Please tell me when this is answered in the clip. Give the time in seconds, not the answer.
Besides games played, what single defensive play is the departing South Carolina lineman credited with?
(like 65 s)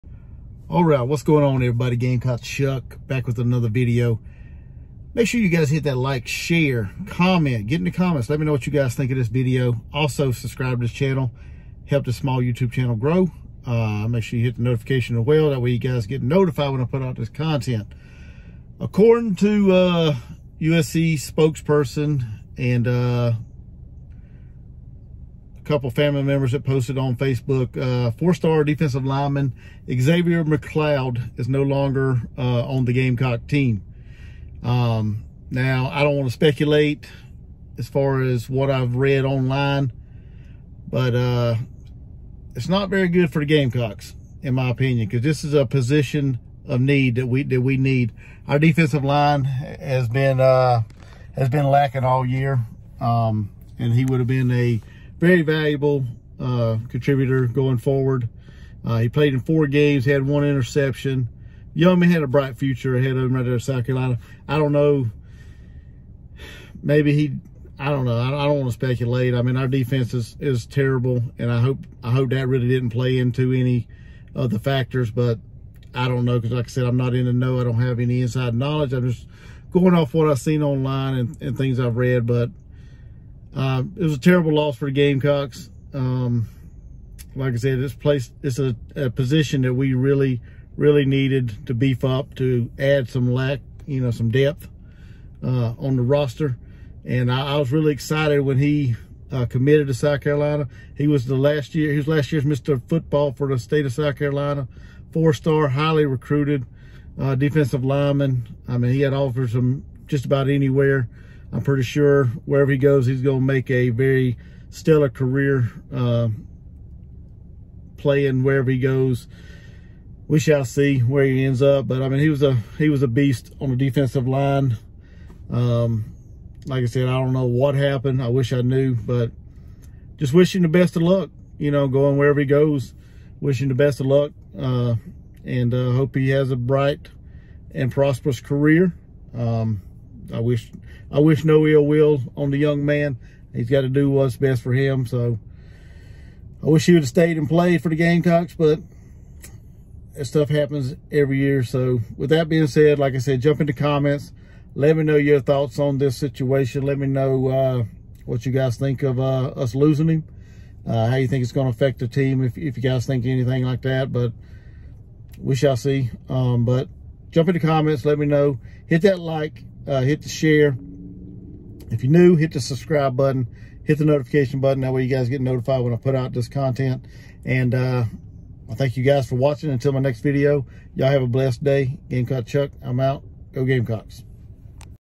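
60 s.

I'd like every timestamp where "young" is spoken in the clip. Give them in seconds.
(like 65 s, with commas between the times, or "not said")
61 s, 142 s.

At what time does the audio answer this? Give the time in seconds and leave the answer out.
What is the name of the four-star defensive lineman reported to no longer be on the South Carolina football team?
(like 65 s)
29 s.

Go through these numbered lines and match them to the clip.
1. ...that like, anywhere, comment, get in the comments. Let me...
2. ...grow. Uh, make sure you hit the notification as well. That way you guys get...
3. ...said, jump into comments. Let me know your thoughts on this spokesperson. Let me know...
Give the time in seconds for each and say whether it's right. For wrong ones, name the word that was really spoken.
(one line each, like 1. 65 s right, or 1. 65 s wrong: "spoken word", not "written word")
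1. 5 s wrong: "share", not "anywhere"
2. 12 s right
3. 153 s wrong: "situation", not "spokesperson".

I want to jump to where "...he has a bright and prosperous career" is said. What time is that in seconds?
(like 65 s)
136 s.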